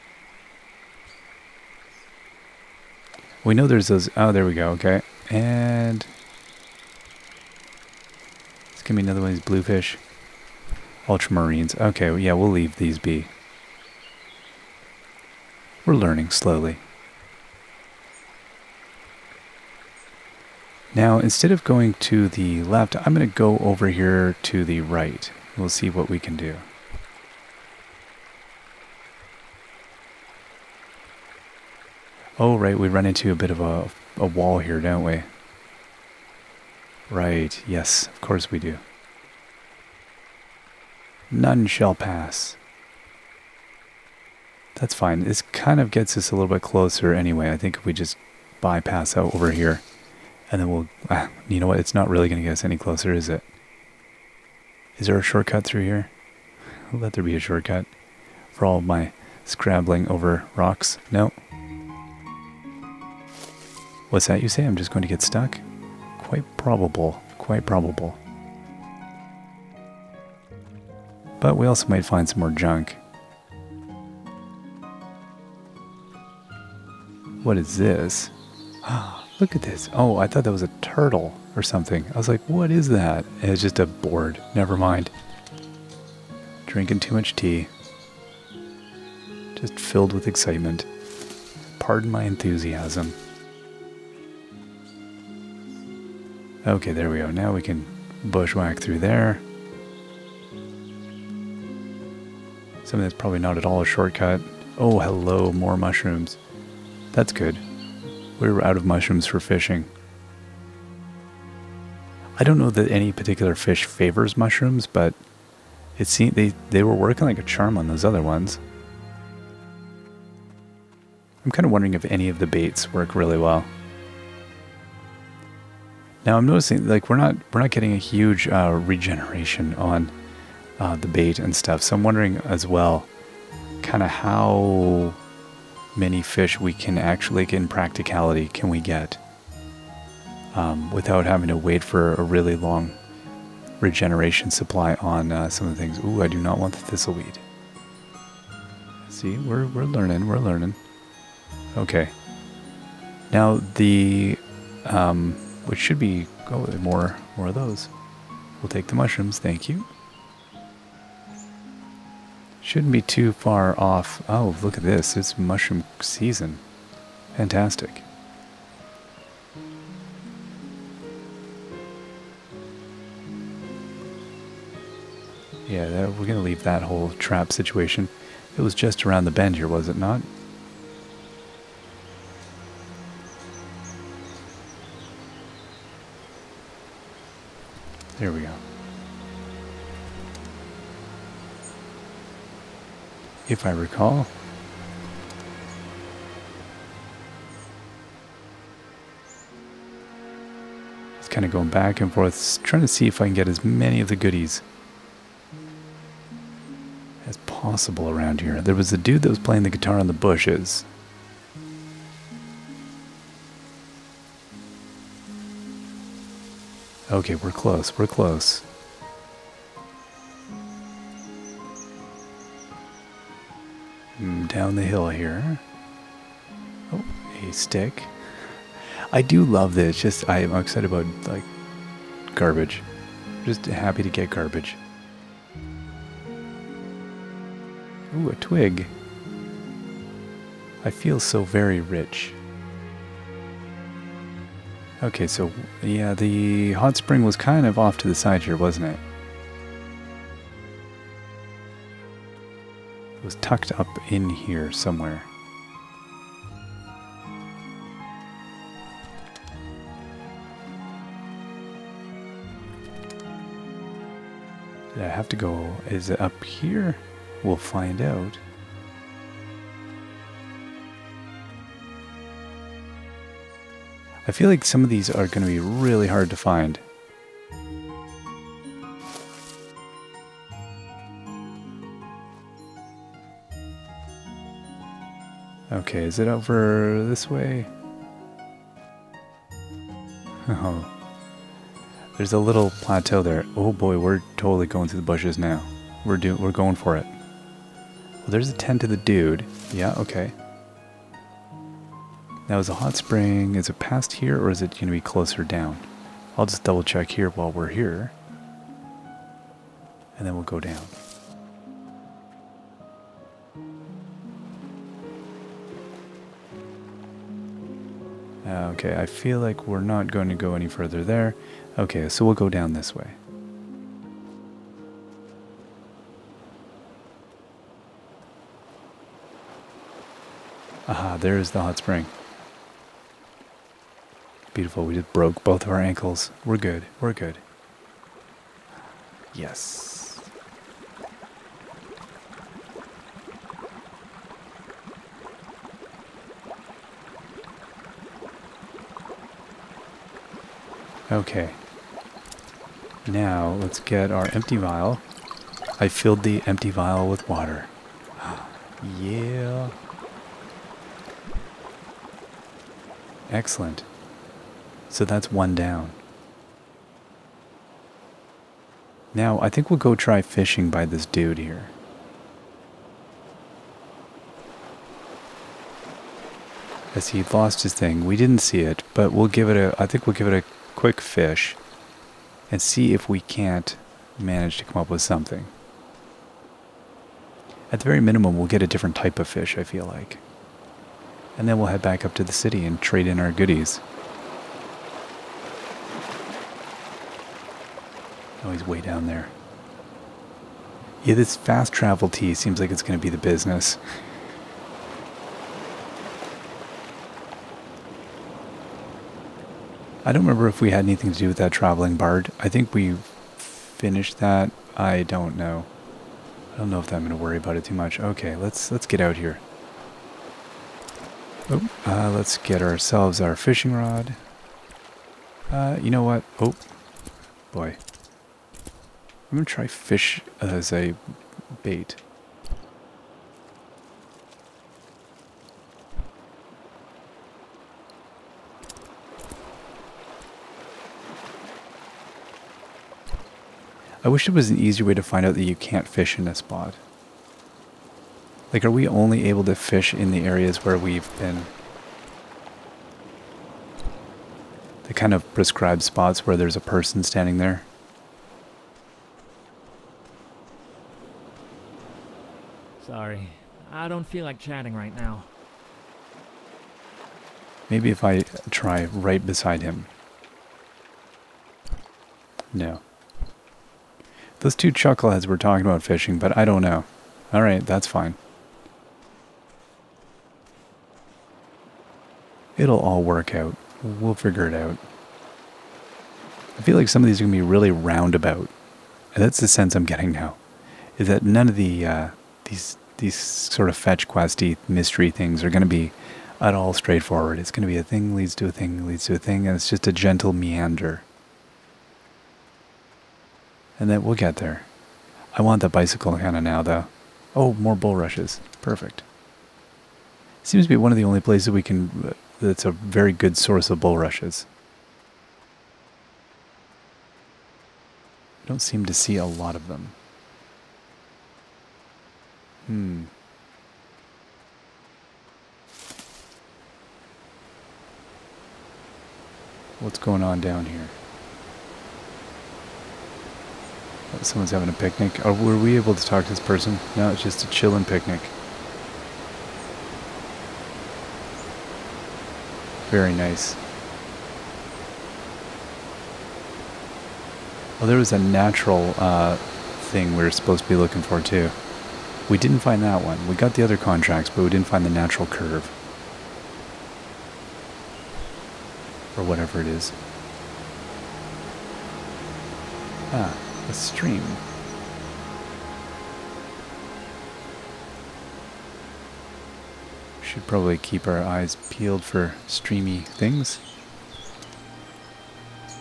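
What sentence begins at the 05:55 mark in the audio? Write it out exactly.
I filled the empty vial with water.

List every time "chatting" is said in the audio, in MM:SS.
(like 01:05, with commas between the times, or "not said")
07:44.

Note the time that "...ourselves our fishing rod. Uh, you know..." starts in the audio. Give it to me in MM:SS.
07:02.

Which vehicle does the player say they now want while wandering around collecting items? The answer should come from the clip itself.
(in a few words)
the bicycle.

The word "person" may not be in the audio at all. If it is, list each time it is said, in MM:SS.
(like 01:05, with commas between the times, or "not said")
07:36, 08:56.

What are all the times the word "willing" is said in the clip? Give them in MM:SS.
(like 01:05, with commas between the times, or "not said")
not said.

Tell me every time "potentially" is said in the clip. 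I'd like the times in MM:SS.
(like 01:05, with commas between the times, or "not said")
not said.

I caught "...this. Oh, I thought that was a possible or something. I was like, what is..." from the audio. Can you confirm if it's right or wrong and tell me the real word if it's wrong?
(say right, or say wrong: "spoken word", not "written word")
wrong: "turtle", not "possible".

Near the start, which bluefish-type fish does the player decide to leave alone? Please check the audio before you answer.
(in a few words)
Ultramarines.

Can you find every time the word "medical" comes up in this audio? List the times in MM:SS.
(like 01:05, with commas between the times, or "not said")
not said.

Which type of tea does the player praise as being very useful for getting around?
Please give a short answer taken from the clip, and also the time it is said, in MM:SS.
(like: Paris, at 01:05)
fast travel tea, at 06:41.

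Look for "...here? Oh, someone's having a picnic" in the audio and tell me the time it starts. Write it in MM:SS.
08:50.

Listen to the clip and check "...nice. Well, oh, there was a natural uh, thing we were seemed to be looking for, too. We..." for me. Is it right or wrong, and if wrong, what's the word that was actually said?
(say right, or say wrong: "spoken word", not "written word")
wrong: "supposed", not "seemed".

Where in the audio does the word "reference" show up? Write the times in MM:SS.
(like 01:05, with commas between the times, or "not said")
not said.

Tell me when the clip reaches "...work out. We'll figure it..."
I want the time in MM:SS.
08:03.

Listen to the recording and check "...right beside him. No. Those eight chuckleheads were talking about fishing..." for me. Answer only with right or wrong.
wrong.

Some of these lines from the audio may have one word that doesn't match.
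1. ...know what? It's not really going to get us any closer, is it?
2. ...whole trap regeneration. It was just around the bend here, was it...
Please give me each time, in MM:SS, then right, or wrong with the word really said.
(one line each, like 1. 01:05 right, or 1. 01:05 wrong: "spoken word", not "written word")
1. 00:51 right
2. 02:56 wrong: "situation", not "regeneration".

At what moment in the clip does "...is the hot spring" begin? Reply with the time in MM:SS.
05:31.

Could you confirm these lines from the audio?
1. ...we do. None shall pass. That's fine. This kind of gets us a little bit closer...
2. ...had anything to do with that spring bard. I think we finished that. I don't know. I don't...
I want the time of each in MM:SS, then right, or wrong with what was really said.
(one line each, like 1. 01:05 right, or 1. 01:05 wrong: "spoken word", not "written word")
1. 00:38 right
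2. 06:50 wrong: "traveling", not "spring".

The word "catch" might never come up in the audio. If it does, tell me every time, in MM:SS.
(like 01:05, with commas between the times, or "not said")
not said.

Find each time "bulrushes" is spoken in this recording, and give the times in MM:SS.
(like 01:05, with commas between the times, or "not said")
08:27, 08:33.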